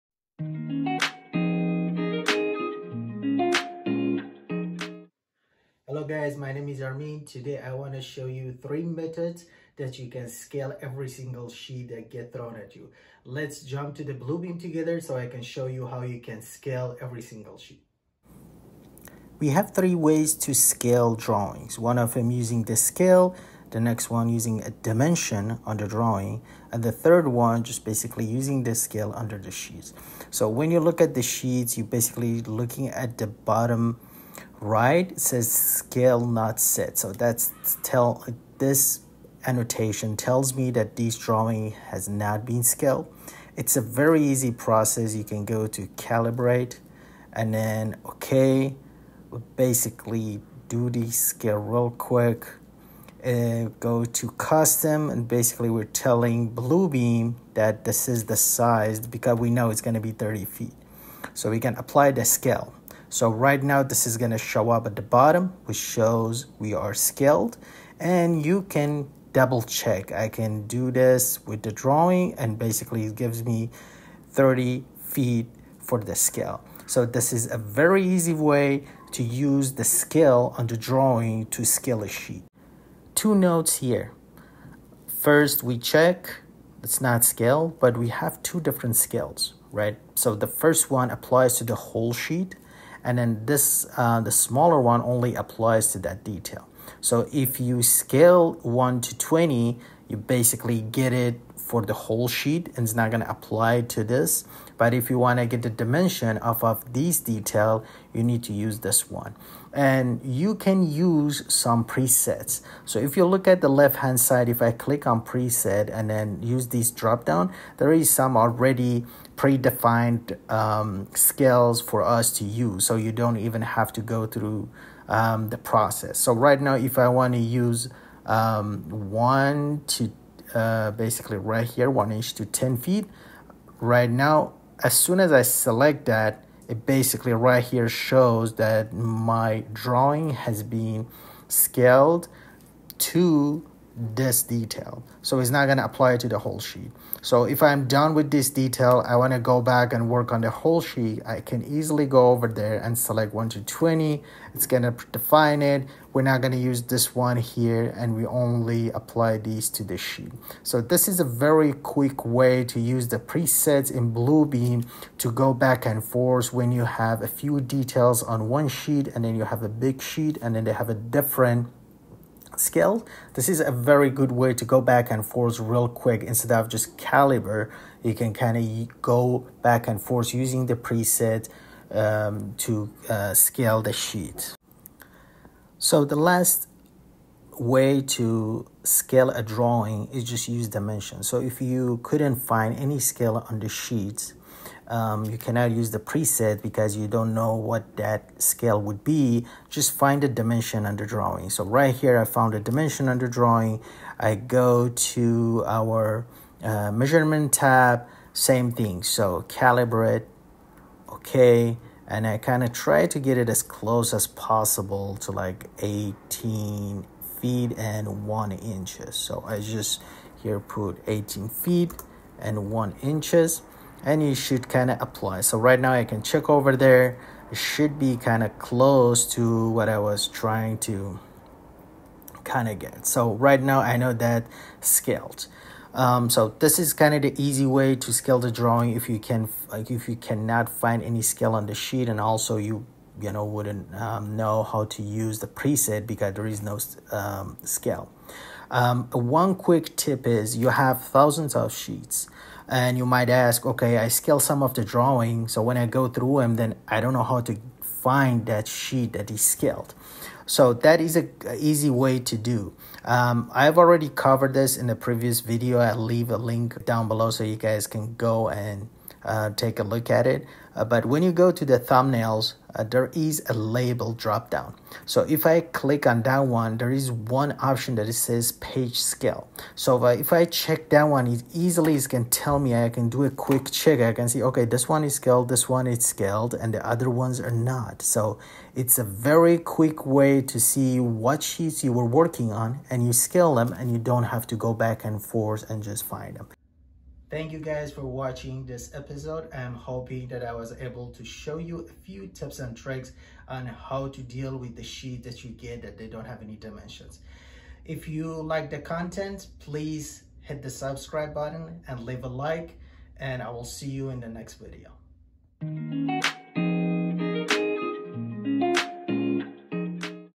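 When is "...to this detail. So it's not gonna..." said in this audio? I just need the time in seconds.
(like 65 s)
142 s.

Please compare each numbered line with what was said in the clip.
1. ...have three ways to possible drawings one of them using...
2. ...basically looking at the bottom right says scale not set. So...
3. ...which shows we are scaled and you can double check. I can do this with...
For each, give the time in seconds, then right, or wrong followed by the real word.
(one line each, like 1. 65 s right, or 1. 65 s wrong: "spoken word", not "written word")
1. 19 s wrong: "scale", not "possible"
2. 31 s right
3. 65 s right.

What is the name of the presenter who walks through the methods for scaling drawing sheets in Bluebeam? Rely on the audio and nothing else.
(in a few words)
Armin.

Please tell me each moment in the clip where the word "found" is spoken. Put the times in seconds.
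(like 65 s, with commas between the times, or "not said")
202 s.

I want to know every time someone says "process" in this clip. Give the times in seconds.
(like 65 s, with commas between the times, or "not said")
44 s, 125 s.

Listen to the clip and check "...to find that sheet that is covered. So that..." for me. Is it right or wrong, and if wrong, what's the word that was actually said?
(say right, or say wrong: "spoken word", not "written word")
wrong: "scaled", not "covered".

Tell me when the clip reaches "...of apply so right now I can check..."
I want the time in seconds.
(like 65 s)
224 s.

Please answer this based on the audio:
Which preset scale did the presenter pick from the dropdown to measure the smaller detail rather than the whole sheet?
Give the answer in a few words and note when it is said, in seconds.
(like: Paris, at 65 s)
1 inch to 10 feet, at 131 s.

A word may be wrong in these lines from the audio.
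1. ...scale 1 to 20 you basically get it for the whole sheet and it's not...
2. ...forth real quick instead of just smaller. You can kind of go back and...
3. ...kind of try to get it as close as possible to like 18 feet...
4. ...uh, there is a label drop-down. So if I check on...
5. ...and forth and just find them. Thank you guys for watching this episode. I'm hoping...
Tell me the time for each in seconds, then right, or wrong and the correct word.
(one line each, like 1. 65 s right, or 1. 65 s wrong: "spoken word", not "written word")
1. 97 s right
2. 175 s wrong: "caliber", not "smaller"
3. 212 s right
4. 272 s wrong: "click", not "check"
5. 295 s right.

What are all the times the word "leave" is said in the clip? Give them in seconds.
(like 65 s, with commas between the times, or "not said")
265 s, 312 s.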